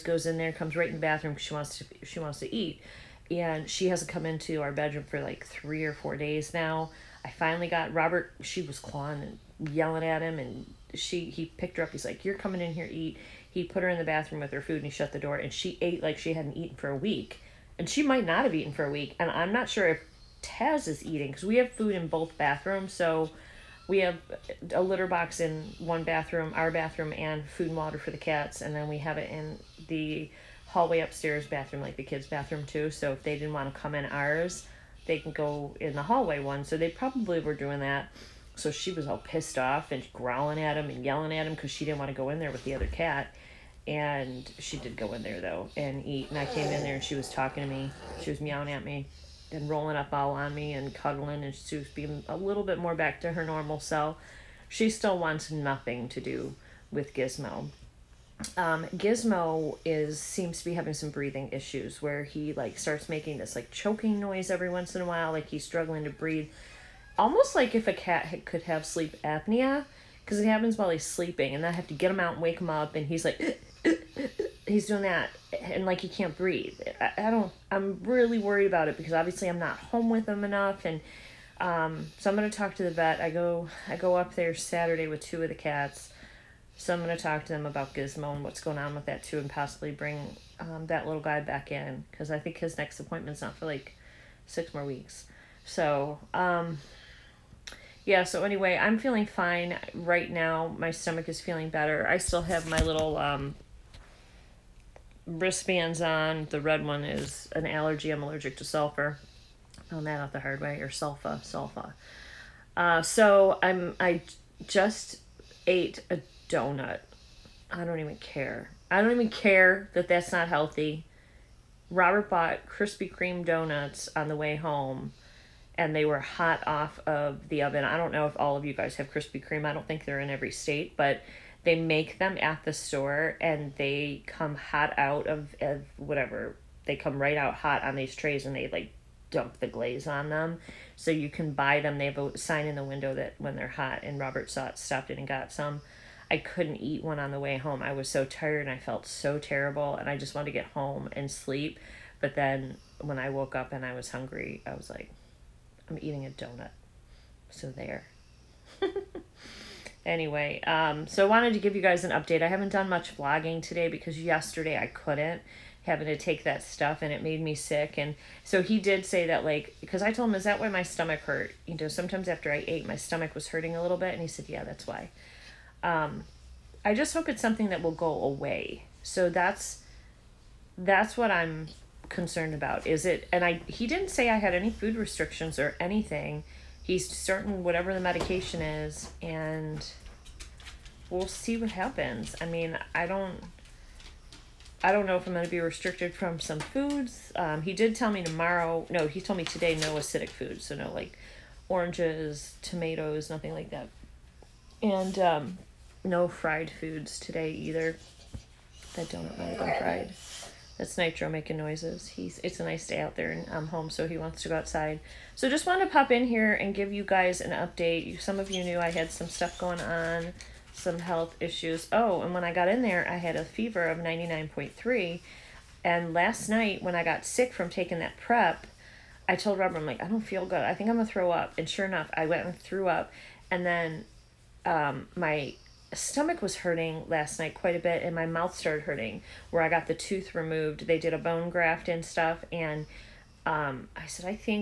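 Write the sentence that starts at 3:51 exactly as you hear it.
And sure enough, I went and threw up.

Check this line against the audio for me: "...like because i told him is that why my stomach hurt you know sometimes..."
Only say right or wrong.
right.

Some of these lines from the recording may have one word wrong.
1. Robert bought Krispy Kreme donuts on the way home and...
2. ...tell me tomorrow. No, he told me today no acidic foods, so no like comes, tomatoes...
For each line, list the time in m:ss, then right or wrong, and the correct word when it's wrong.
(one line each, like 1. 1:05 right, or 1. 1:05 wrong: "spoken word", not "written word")
1. 2:01 right
2. 3:17 wrong: "oranges", not "comes".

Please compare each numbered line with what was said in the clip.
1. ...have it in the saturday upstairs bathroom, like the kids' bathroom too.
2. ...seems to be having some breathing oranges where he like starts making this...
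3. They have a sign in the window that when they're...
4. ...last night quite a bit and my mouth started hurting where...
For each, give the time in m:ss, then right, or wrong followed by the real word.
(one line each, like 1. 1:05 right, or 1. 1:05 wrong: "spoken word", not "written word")
1. 0:28 wrong: "hallway", not "saturday"
2. 1:00 wrong: "issues", not "oranges"
3. 2:21 right
4. 3:57 right.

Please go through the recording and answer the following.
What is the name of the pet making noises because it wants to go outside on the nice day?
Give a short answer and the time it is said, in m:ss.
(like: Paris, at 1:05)
Nitro, at 3:30.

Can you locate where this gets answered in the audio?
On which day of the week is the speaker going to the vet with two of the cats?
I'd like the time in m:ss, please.
1:24.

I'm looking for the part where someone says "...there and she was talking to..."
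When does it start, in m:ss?
0:46.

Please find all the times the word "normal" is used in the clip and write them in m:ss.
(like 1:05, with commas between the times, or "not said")
0:53.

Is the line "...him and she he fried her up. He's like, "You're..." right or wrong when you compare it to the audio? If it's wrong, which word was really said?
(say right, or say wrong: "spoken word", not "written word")
wrong: "picked", not "fried".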